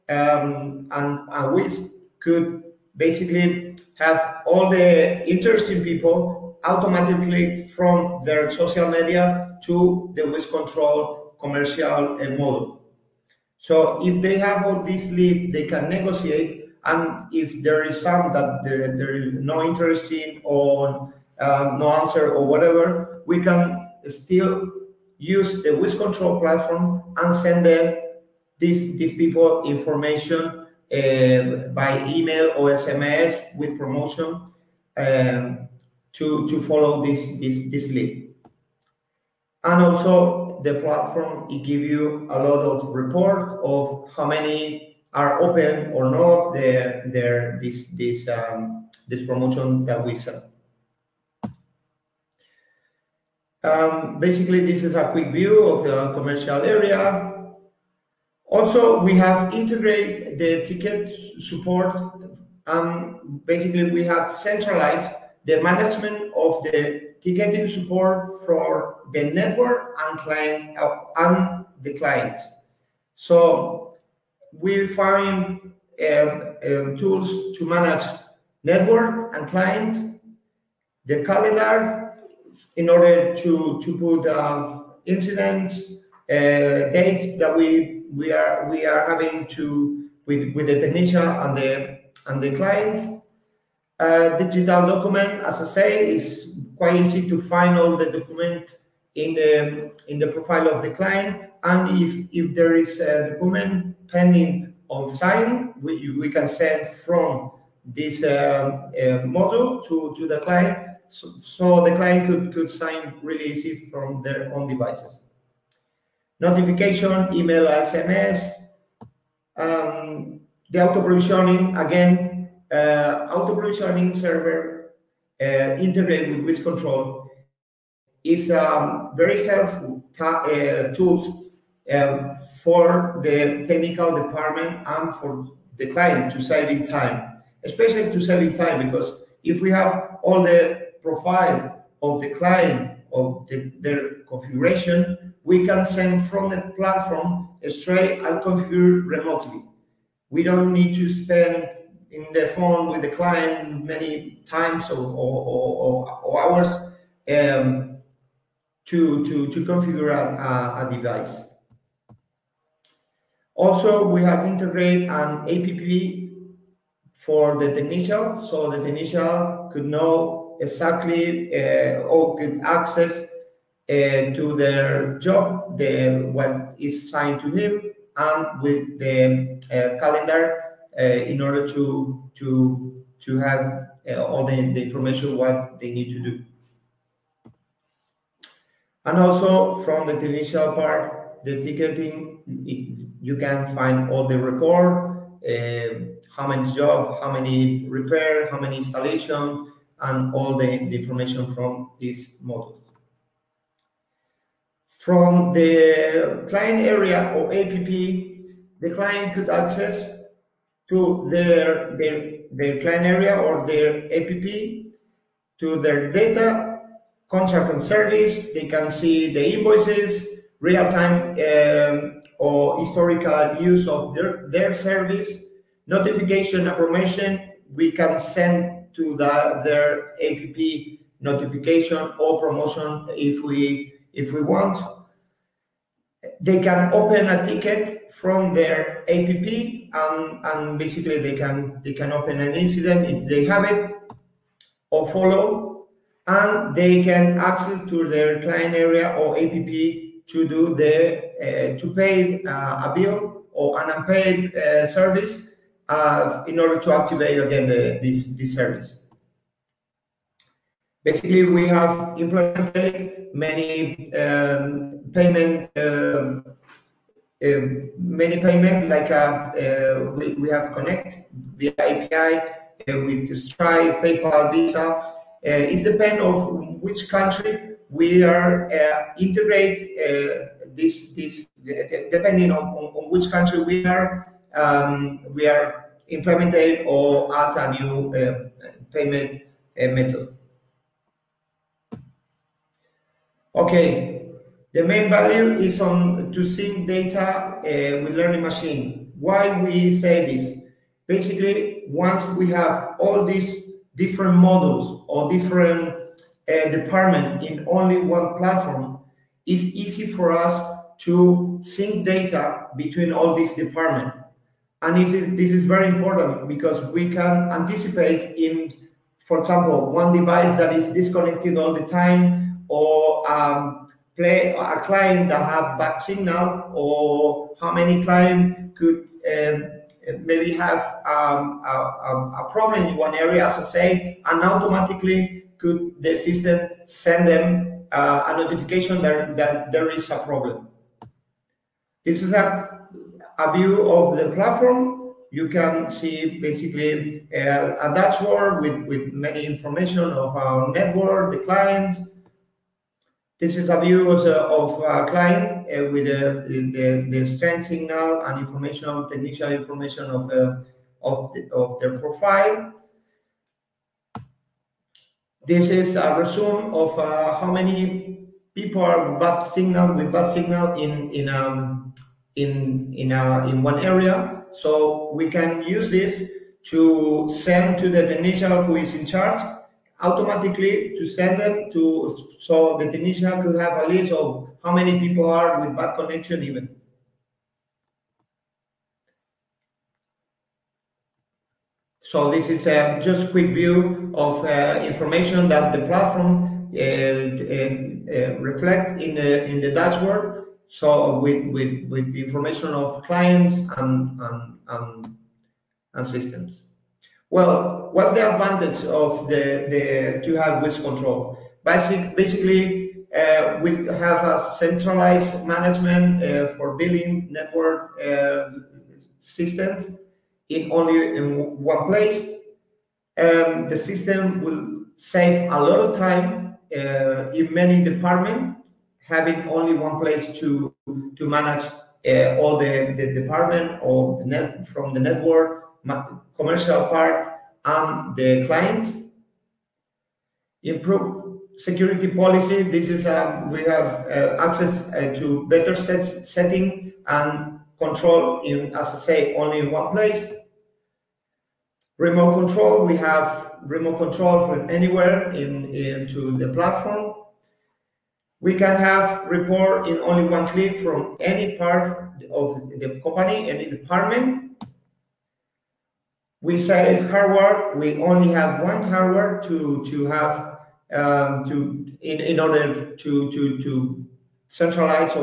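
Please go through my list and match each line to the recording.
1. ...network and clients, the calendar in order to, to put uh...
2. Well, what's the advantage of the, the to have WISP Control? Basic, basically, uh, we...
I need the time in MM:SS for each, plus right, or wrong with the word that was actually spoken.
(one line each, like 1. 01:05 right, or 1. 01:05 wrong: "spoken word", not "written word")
1. 01:18 right
2. 06:47 right.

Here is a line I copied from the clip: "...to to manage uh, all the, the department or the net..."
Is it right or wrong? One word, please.
right.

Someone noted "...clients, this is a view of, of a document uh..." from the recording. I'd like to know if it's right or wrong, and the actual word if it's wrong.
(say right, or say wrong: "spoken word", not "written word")
wrong: "client", not "document".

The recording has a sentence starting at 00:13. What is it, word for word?
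So if they have all this lead, they can negotiate.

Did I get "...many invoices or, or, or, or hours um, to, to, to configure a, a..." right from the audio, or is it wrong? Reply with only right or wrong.
wrong.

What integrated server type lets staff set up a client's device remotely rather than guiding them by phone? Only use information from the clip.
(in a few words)
Auto provisioning server.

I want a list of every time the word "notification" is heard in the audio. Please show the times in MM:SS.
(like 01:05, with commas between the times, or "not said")
01:56, 03:45, 03:51, 05:38.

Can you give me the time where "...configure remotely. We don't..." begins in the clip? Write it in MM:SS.
02:28.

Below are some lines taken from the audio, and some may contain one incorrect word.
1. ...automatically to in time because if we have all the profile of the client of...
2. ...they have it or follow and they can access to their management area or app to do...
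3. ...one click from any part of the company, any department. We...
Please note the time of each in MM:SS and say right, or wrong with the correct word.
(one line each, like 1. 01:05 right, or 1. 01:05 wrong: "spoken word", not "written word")
1. 02:17 wrong: "especially", not "automatically"
2. 04:03 wrong: "client", not "management"
3. 07:40 right.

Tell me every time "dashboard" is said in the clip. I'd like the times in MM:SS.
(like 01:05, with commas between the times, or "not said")
05:47, 06:39.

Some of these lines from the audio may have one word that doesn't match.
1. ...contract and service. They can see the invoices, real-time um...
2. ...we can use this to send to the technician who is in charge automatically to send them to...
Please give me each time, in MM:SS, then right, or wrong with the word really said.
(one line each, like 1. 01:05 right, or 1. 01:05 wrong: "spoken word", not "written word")
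1. 03:37 right
2. 06:15 right.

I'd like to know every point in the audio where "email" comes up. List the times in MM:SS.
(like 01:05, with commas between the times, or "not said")
00:32, 01:57.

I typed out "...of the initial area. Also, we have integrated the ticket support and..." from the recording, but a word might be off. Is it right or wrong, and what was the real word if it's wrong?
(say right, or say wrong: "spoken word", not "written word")
wrong: "commercial", not "initial".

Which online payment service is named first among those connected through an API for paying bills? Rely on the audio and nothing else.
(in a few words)
Stripe.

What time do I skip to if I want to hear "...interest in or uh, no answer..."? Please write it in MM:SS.
00:19.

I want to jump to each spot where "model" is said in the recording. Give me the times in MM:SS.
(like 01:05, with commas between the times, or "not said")
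00:12, 01:49, 03:22, 05:04.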